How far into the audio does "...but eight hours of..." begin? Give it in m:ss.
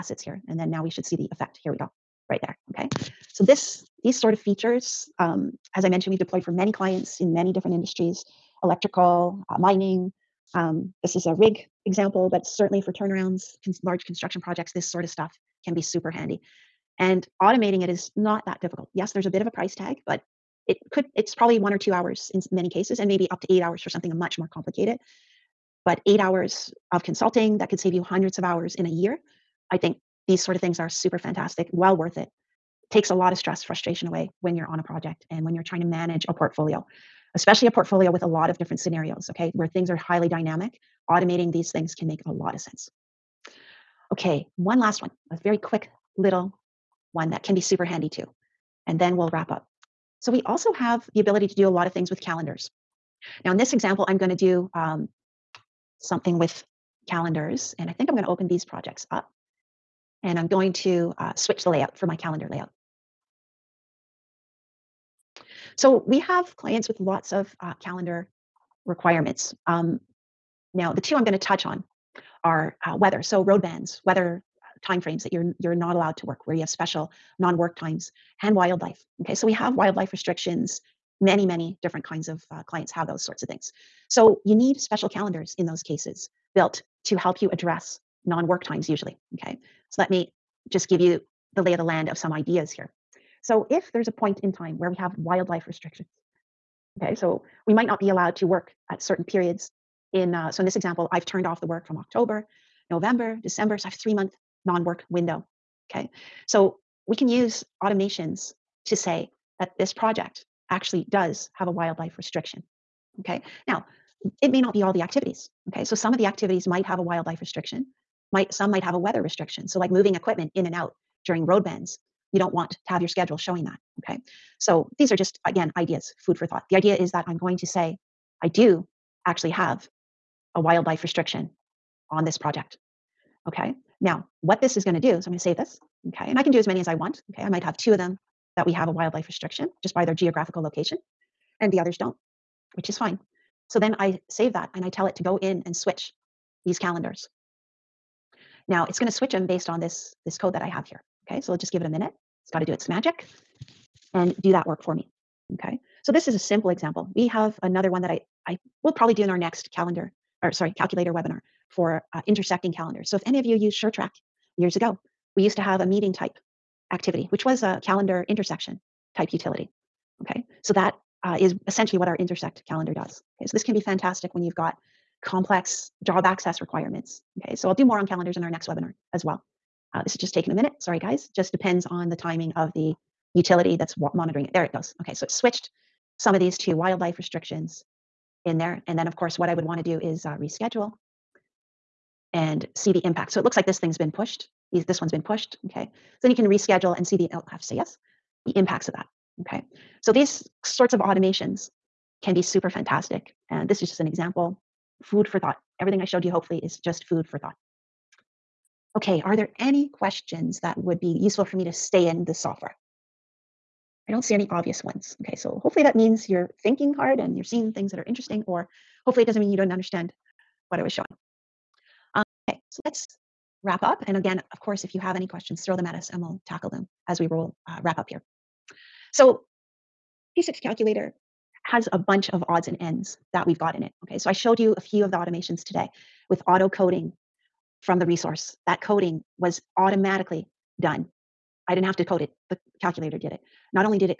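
0:25.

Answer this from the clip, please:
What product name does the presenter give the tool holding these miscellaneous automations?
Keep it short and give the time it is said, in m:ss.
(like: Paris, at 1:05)
P6 calculator, at 3:50.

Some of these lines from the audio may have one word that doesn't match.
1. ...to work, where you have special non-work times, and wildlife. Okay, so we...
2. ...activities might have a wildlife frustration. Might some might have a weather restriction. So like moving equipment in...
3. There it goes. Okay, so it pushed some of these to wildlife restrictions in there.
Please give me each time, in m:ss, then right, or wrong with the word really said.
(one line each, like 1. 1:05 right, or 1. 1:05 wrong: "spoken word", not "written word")
1. 1:16 right
2. 1:56 wrong: "restriction", not "frustration"
3. 3:04 wrong: "switched", not "pushed".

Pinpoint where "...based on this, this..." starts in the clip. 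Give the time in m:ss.
2:29.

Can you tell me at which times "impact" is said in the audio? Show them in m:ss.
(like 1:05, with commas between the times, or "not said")
3:13, 3:18.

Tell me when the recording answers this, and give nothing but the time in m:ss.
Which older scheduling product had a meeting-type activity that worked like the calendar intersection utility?
2:43.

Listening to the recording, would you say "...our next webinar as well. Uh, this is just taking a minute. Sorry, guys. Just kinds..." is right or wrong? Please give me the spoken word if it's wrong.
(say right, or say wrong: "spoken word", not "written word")
wrong: "depends", not "kinds".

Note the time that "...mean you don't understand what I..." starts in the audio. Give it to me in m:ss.
3:39.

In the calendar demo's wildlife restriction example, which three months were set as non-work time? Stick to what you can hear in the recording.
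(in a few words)
October, November, December.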